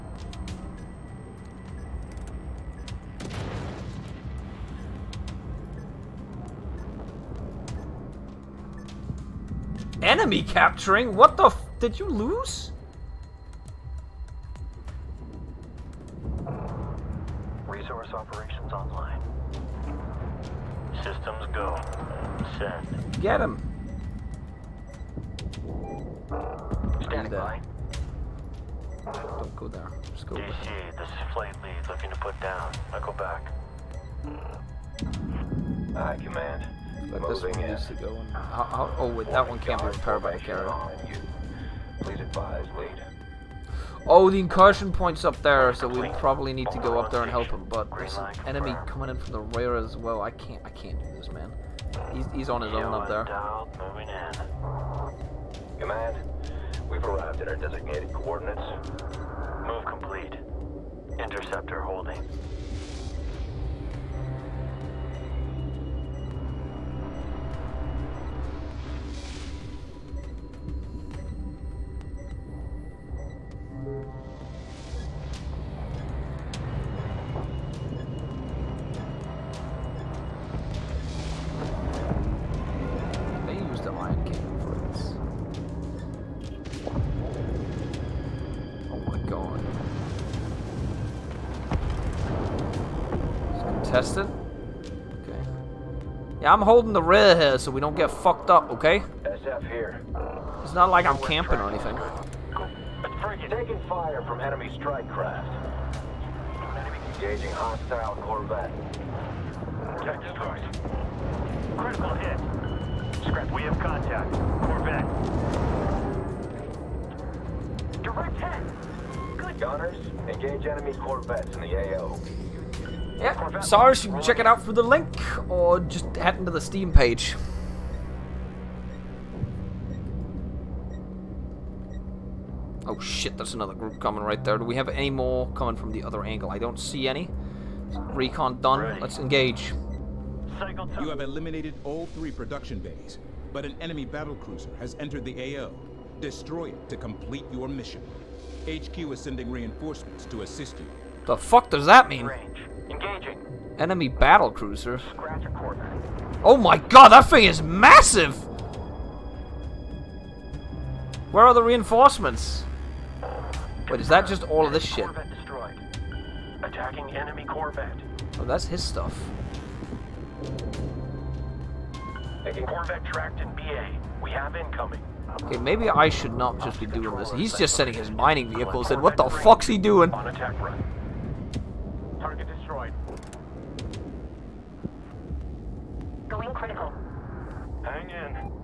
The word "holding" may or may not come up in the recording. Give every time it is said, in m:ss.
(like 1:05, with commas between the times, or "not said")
1:01, 1:36.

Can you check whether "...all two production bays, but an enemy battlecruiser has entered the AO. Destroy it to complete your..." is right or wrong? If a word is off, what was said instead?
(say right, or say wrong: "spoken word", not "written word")
wrong: "three", not "two".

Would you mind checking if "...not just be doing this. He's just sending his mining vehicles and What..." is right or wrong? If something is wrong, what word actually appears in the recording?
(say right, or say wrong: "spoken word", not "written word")
right.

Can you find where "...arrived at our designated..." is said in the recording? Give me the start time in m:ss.
0:57.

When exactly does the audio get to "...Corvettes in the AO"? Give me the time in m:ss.
2:00.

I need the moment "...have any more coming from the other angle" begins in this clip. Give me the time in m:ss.
2:14.